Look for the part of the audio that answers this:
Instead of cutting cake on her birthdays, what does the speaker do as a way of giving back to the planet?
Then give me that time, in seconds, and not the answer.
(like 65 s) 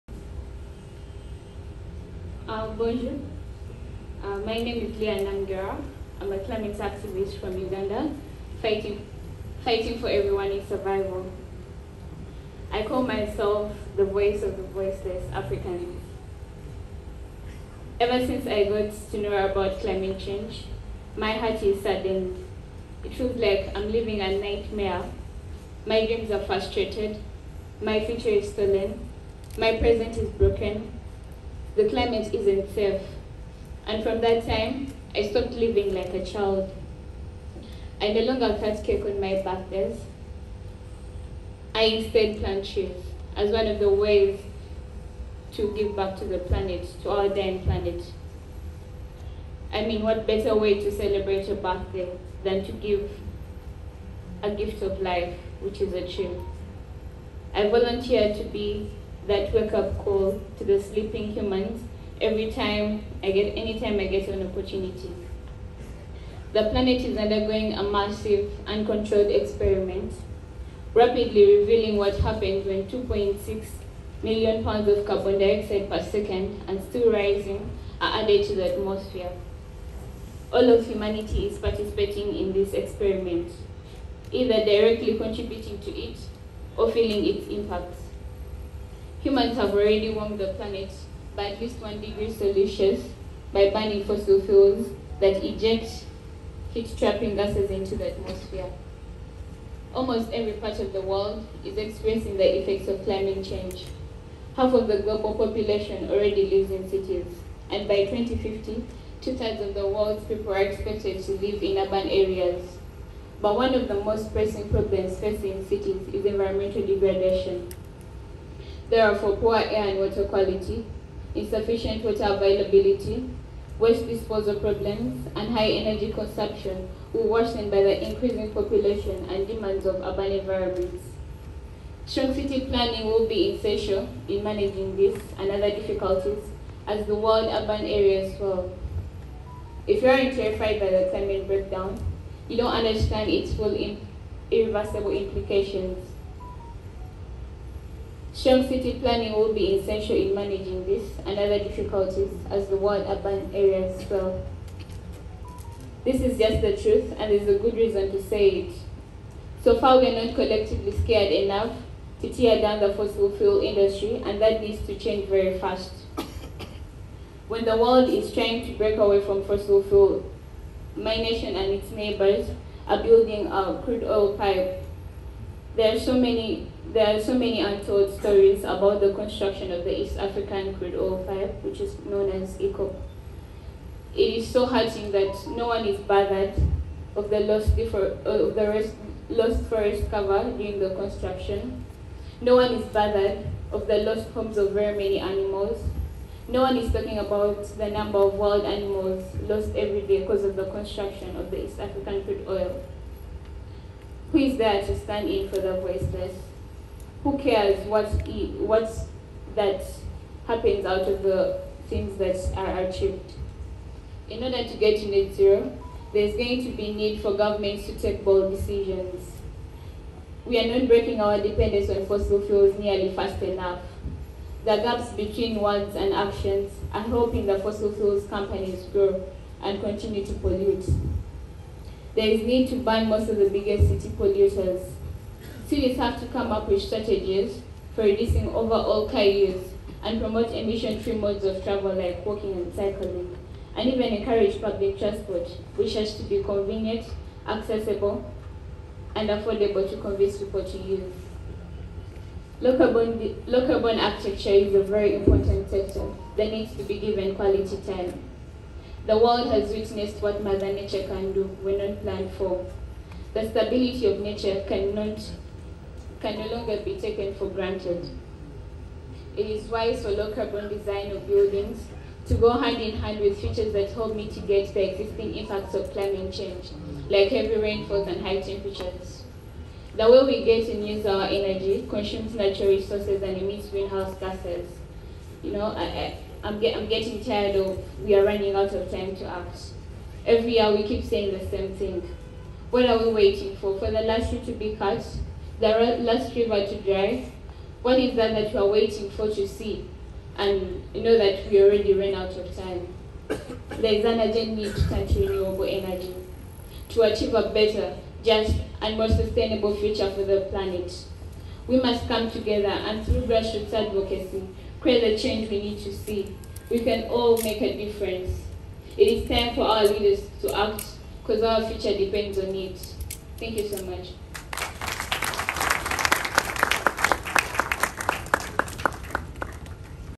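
42 s.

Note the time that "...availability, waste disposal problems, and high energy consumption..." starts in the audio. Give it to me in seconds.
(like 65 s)
122 s.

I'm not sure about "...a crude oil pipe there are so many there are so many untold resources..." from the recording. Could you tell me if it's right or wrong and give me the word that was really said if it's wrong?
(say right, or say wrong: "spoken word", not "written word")
wrong: "stories", not "resources".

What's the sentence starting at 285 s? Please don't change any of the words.
You know, I, I'm, get, I'm getting tired of we are running out of time to act.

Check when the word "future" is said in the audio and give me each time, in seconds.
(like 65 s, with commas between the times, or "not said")
28 s, 309 s, 321 s.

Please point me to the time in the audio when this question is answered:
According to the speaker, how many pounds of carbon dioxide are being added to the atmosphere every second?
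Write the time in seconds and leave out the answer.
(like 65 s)
72 s.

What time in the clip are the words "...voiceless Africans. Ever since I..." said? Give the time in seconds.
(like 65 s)
14 s.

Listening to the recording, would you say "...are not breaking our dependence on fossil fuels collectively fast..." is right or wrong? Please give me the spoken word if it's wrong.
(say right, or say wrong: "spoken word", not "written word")
wrong: "nearly", not "collectively".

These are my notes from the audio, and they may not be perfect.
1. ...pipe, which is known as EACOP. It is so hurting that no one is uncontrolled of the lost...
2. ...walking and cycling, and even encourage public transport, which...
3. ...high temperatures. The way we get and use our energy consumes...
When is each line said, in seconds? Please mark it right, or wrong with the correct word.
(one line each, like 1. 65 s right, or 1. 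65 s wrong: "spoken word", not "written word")
1. 181 s wrong: "bothered", not "uncontrolled"
2. 242 s right
3. 278 s right.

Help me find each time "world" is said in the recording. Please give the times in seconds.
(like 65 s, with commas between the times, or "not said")
101 s, 109 s, 137 s, 152 s, 167 s, 259 s.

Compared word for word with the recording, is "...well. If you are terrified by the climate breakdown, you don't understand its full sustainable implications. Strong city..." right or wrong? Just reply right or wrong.
wrong.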